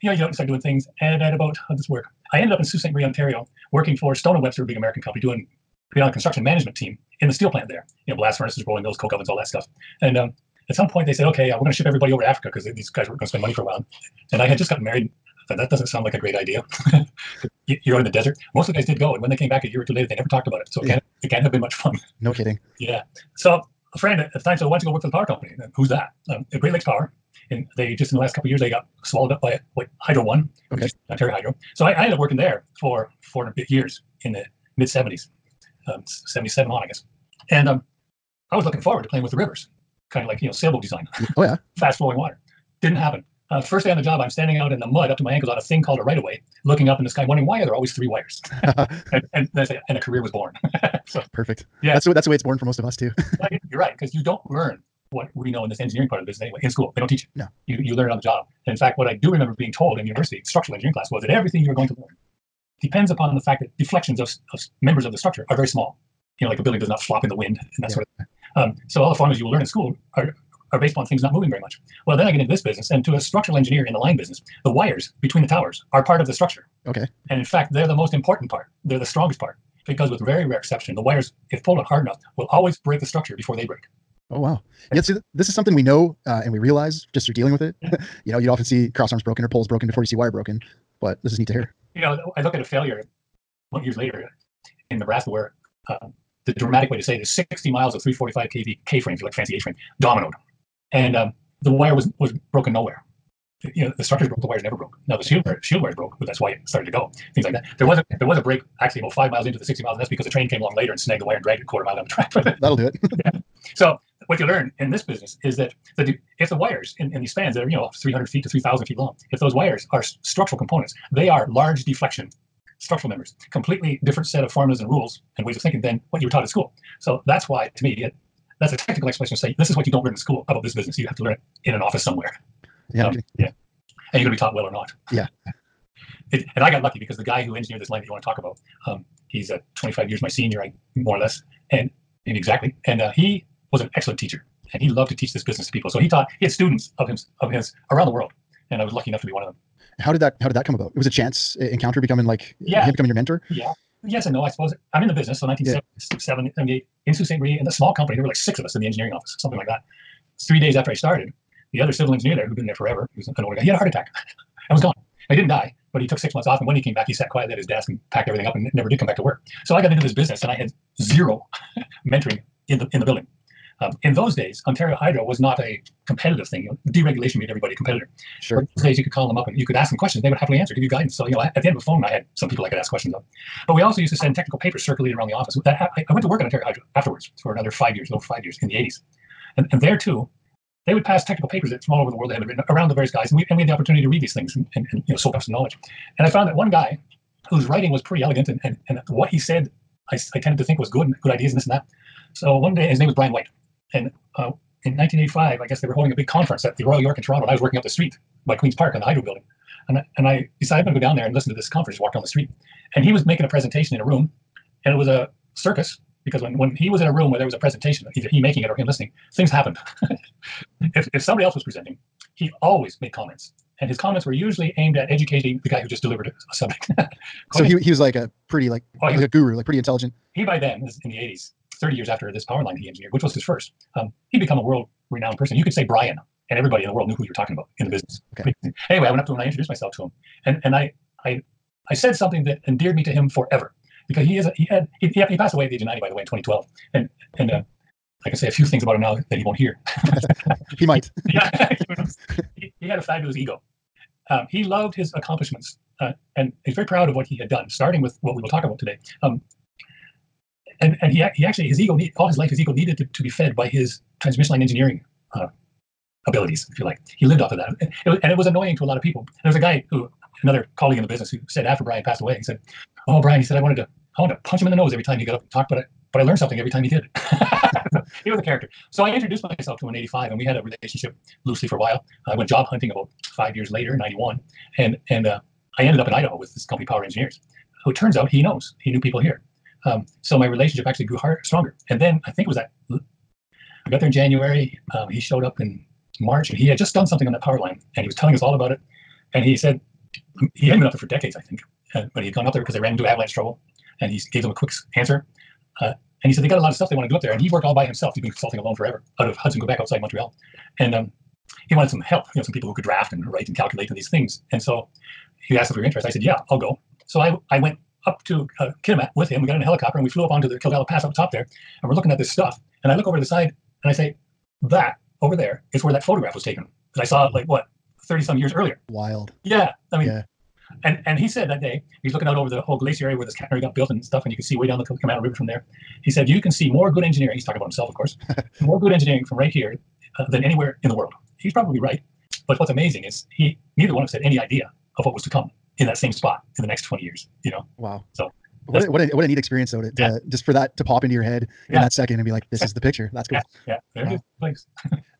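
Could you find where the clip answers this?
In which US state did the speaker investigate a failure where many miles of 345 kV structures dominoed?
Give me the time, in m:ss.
1:34.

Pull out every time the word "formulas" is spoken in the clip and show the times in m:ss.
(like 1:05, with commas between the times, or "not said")
1:09, 2:04.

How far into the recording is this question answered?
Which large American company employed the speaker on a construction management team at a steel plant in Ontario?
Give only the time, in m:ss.
0:04.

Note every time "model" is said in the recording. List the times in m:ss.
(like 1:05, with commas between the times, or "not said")
not said.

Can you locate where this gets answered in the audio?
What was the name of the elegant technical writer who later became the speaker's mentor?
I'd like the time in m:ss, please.
3:23.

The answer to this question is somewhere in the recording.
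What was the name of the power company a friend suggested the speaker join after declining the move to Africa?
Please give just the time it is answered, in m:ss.
0:26.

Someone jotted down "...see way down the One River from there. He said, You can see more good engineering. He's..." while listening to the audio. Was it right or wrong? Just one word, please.
wrong.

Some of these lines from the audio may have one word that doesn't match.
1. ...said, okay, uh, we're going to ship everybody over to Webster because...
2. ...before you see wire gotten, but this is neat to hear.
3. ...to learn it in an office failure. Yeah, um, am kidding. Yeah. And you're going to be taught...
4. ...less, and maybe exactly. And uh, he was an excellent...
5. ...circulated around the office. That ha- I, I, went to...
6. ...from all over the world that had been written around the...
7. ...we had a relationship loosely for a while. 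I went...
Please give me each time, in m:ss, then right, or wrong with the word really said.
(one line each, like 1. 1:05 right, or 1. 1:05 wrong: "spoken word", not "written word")
1. 0:11 wrong: "Africa", not "Webster"
2. 1:29 wrong: "broken", not "gotten"
3. 2:11 wrong: "somewhere", not "failure"
4. 2:21 right
5. 3:04 right
6. 3:11 right
7. 4:40 right.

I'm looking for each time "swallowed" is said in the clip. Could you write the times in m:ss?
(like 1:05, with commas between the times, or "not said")
0:29.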